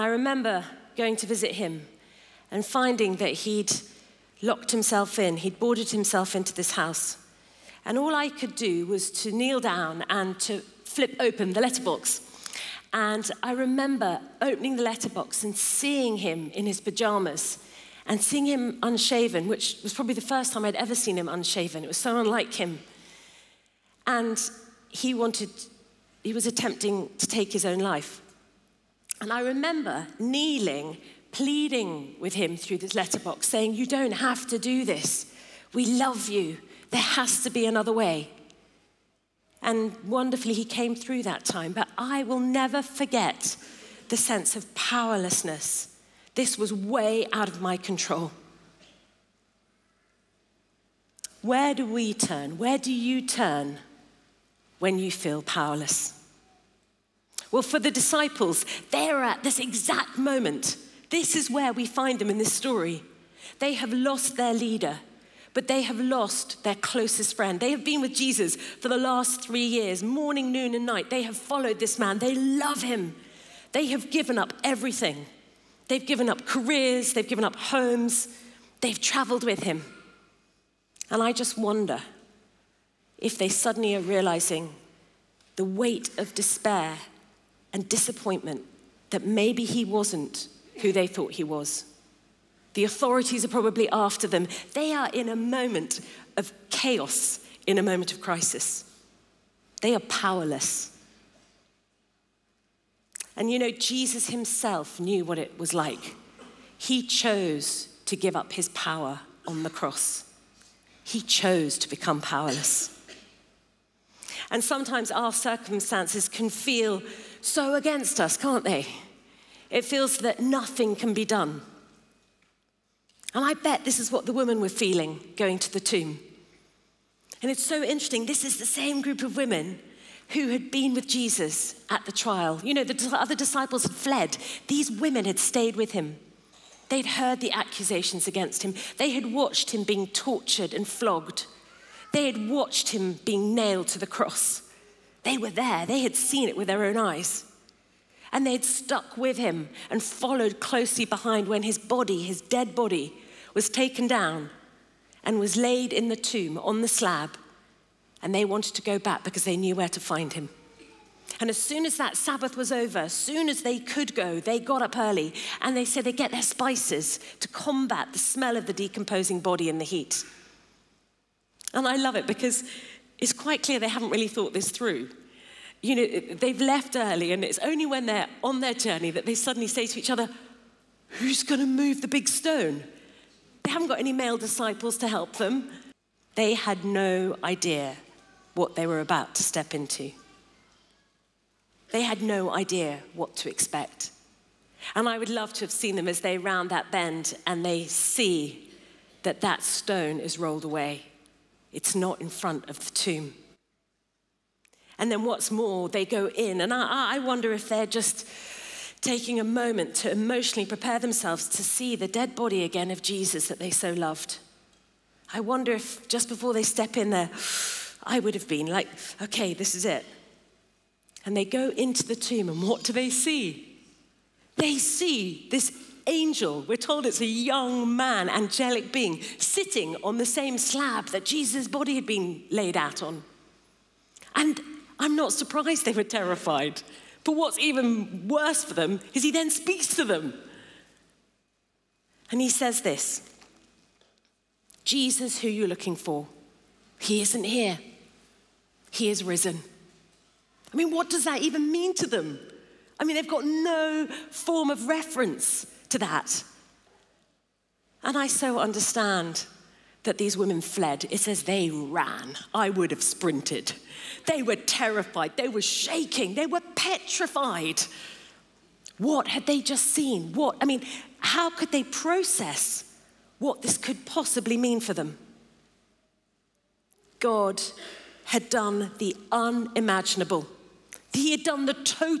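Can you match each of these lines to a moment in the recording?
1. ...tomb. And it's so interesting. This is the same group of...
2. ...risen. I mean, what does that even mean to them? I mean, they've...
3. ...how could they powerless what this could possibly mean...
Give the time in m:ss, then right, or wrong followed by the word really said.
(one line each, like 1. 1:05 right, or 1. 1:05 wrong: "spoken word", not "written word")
1. 2:05 right
2. 4:09 right
3. 4:31 wrong: "process", not "powerless".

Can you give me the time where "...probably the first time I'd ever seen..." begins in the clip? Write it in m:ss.
0:19.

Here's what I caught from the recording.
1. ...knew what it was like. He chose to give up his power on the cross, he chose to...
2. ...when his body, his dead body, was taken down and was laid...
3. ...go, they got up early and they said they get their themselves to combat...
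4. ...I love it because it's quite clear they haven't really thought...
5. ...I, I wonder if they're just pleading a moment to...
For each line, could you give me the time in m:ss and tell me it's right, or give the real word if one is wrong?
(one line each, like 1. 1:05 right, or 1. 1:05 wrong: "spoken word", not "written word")
1. 1:45 right
2. 2:31 right
3. 2:44 wrong: "spices", not "themselves"
4. 2:51 right
5. 3:26 wrong: "taking", not "pleading".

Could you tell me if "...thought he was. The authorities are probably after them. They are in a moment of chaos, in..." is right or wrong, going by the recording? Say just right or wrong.
right.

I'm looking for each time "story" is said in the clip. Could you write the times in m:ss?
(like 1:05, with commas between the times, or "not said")
1:02.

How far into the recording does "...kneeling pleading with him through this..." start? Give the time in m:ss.
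0:30.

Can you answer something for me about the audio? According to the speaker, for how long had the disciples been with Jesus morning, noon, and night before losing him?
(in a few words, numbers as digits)
3 years.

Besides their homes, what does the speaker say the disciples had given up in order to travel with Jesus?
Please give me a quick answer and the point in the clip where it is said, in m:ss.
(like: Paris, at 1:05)
careers, at 1:16.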